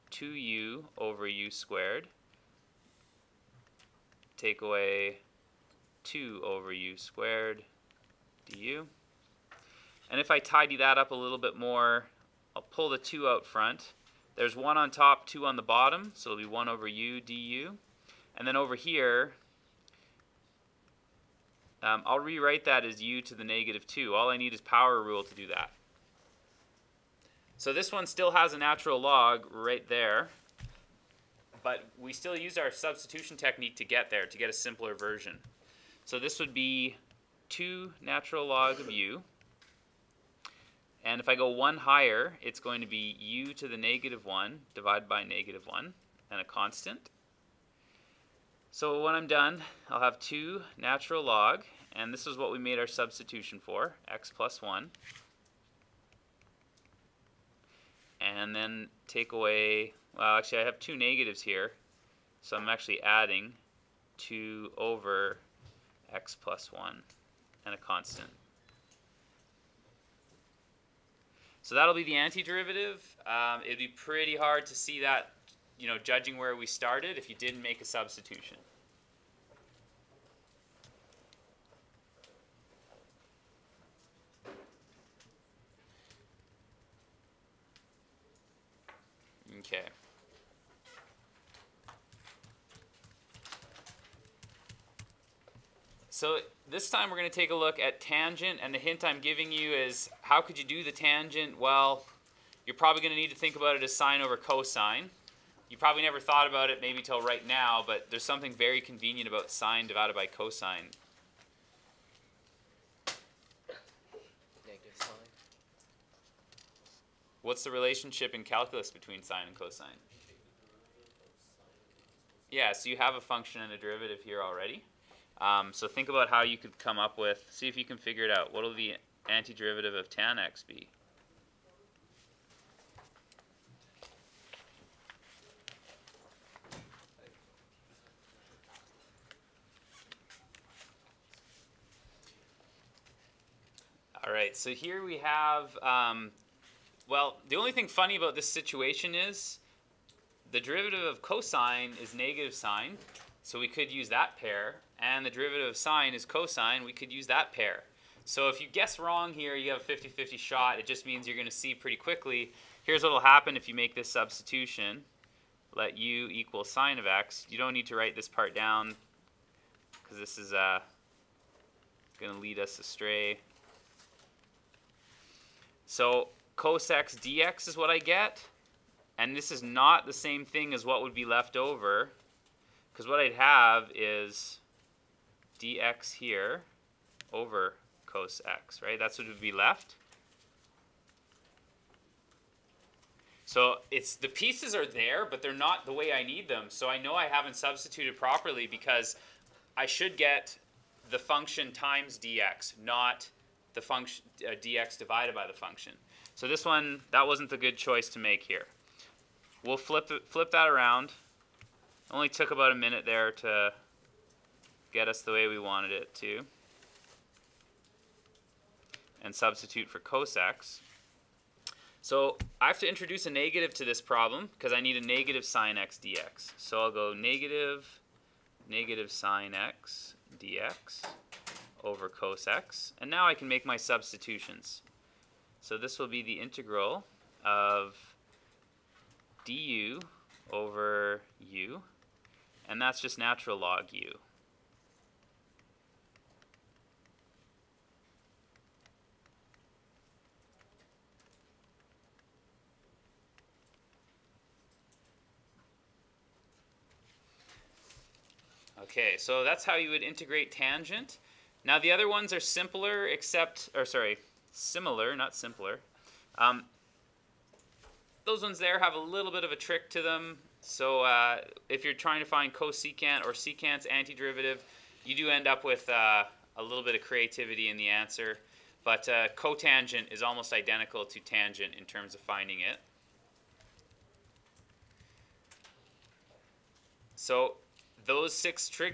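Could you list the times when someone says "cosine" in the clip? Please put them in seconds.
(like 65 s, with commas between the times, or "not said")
104 s, 110 s, 119 s, 151 s, 156 s.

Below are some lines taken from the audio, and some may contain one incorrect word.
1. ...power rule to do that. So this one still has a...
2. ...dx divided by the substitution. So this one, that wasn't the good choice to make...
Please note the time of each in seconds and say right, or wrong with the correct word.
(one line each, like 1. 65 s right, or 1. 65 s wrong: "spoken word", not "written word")
1. 24 s right
2. 204 s wrong: "function", not "substitution".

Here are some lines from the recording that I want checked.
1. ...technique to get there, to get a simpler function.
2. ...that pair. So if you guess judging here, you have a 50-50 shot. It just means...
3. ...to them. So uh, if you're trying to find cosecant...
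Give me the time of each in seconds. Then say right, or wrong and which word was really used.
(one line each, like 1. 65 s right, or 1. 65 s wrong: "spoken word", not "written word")
1. 33 s wrong: "version", not "function"
2. 157 s wrong: "wrong", not "judging"
3. 269 s right.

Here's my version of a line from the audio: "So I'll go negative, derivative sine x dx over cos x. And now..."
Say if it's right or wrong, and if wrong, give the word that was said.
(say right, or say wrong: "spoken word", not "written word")
wrong: "negative", not "derivative".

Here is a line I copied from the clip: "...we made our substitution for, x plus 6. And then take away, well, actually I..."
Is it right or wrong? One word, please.
wrong.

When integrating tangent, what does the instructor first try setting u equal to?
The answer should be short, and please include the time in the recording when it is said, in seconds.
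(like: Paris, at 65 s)
sine of x, at 166 s.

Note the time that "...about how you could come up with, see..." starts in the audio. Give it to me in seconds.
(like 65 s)
126 s.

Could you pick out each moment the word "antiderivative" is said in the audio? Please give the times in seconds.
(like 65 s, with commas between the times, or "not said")
72 s, 129 s, 273 s.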